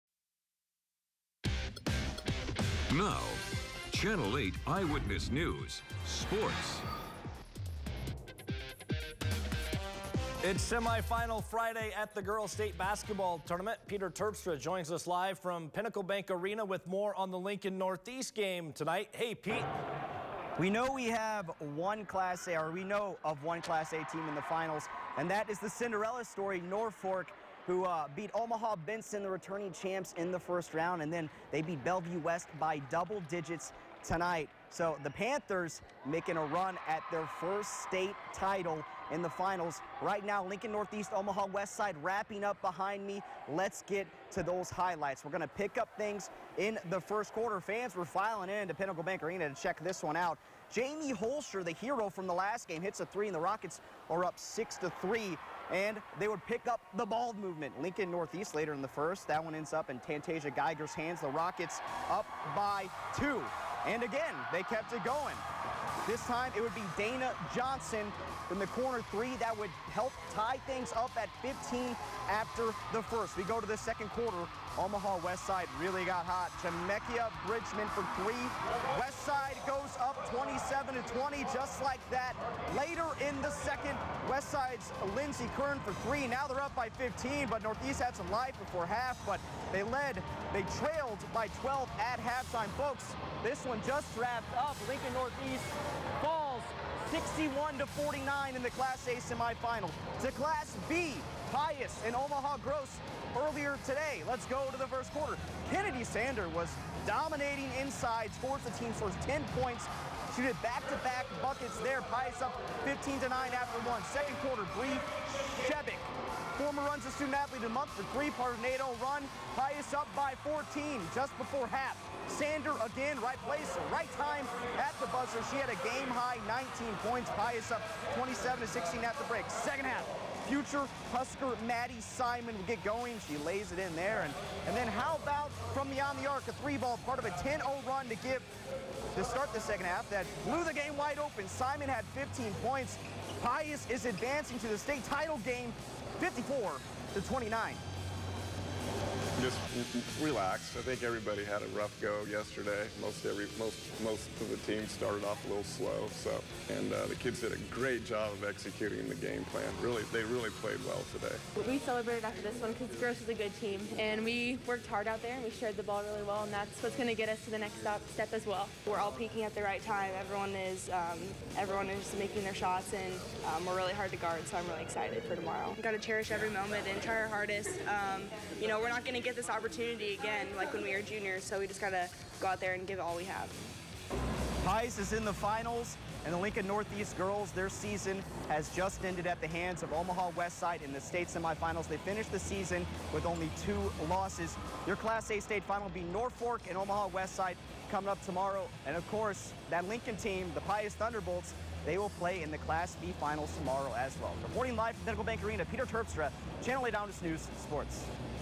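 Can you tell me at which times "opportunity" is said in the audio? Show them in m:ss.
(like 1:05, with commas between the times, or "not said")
2:59.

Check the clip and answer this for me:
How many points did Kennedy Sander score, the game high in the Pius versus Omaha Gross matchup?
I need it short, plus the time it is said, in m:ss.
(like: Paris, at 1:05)
19, at 2:06.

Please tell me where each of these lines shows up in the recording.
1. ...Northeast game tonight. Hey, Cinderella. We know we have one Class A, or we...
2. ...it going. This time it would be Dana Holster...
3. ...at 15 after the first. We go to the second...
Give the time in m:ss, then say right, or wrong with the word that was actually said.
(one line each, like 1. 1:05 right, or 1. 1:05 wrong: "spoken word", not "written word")
1. 0:17 wrong: "Pete", not "Cinderella"
2. 1:04 wrong: "Johnson", not "Holster"
3. 1:11 right.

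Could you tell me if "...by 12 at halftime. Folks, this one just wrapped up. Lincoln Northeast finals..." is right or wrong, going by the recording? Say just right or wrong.
wrong.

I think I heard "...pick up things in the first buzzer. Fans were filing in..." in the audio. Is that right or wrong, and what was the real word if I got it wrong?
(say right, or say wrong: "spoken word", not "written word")
wrong: "quarter", not "buzzer".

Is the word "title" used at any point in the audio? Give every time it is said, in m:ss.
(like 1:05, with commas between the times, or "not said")
0:38, 2:25.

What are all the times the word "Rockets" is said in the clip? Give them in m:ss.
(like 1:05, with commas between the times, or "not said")
0:53, 1:01.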